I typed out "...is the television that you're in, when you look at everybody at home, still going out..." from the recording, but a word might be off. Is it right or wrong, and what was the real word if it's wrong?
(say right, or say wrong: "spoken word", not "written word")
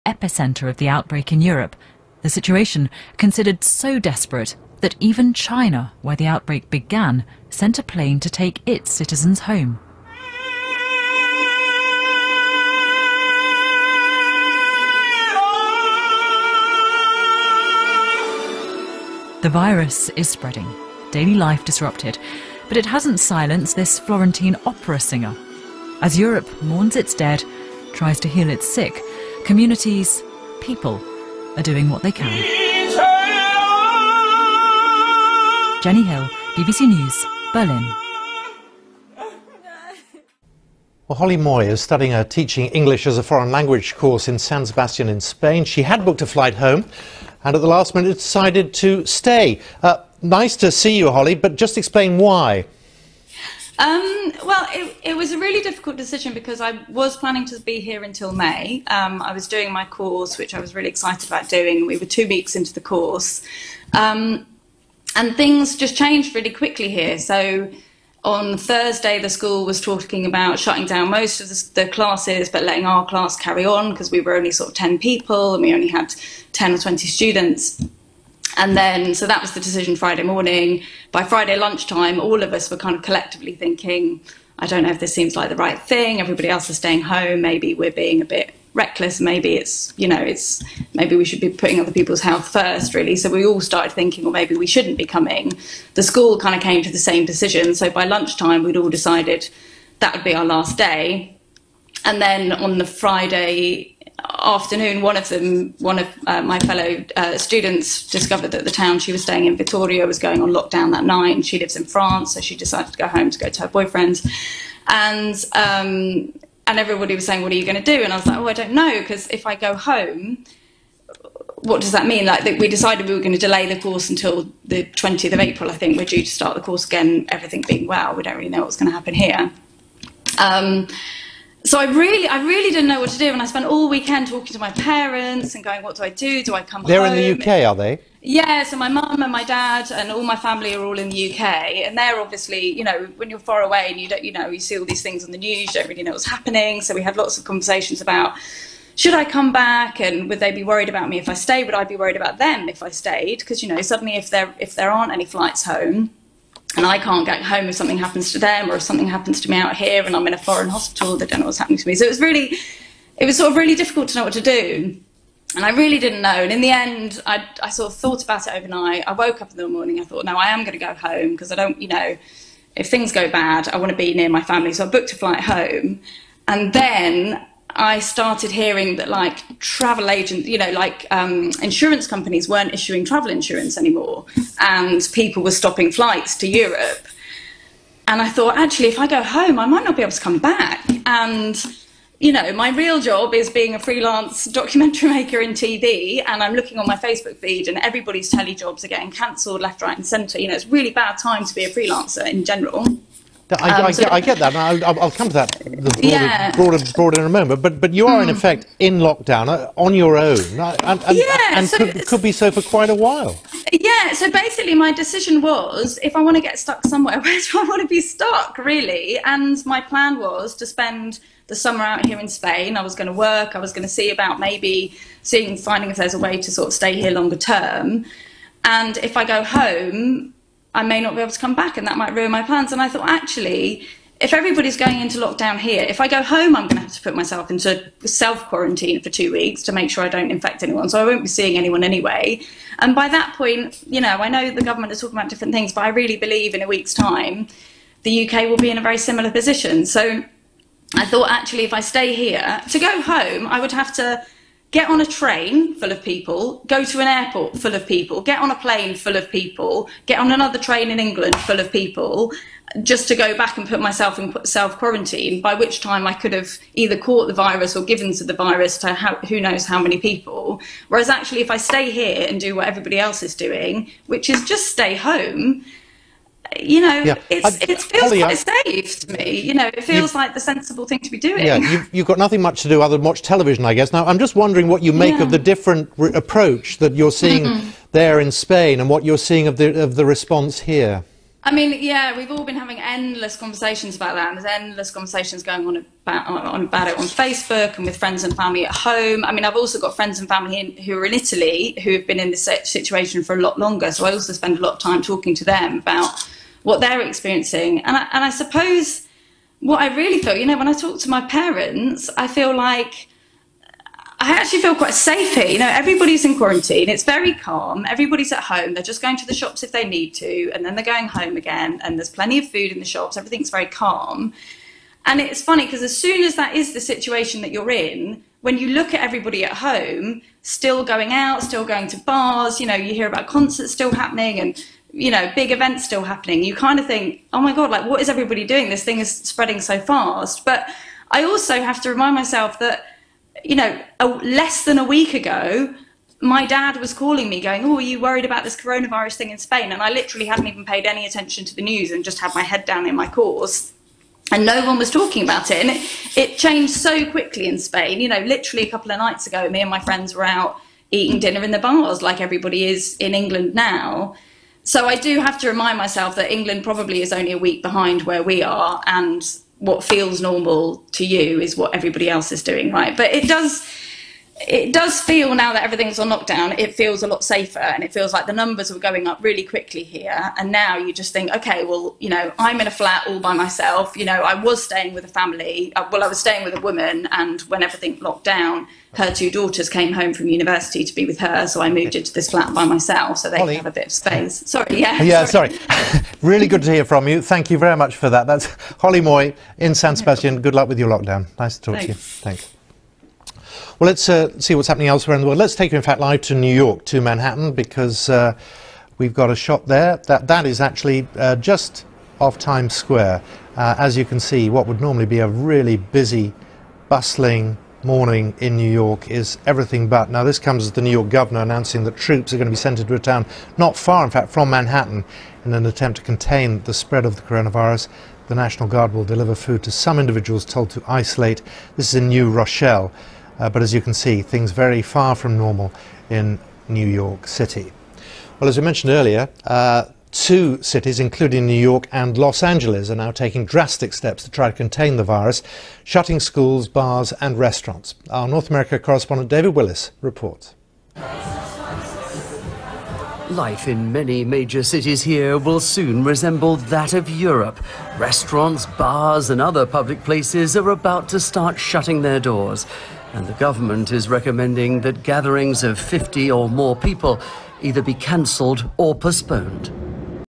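wrong: "situation", not "television".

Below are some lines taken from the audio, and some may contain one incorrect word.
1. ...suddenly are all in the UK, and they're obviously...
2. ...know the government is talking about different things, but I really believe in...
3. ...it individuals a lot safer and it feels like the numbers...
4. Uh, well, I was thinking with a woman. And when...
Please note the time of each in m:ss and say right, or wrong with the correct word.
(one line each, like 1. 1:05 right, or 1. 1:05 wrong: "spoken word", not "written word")
1. 2:20 wrong: "family", not "suddenly"
2. 4:04 right
3. 6:16 wrong: "feels", not "individuals"
4. 6:25 wrong: "staying", not "thinking".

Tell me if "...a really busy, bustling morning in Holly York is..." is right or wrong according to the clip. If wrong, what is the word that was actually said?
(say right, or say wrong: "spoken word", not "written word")
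wrong: "New", not "Holly".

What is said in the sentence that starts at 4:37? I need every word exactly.
it's, it feels Holly, quite I, safe to me.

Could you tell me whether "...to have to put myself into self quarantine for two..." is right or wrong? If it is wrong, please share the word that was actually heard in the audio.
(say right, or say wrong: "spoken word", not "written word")
right.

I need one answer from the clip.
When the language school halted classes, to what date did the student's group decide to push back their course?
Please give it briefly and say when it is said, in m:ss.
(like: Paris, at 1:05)
20th of April, at 2:04.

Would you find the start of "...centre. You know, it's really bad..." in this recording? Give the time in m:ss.
3:20.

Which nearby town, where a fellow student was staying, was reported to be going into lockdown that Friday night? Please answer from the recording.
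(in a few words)
Vitoria.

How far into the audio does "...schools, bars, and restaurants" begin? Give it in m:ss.
7:26.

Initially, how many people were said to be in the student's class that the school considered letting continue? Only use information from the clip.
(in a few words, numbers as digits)
10.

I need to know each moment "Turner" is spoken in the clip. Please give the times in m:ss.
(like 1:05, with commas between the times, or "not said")
not said.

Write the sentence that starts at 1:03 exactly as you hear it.
Um, and things just changed really quickly here.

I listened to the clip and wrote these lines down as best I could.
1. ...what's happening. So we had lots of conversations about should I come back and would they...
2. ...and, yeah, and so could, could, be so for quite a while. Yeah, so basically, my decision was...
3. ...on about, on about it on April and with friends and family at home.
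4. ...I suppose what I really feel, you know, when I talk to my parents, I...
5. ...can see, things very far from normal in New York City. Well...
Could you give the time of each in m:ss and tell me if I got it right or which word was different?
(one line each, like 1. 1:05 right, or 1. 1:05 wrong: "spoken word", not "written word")
1. 2:26 right
2. 3:31 right
3. 4:55 wrong: "Facebook", not "April"
4. 5:08 right
5. 7:13 right.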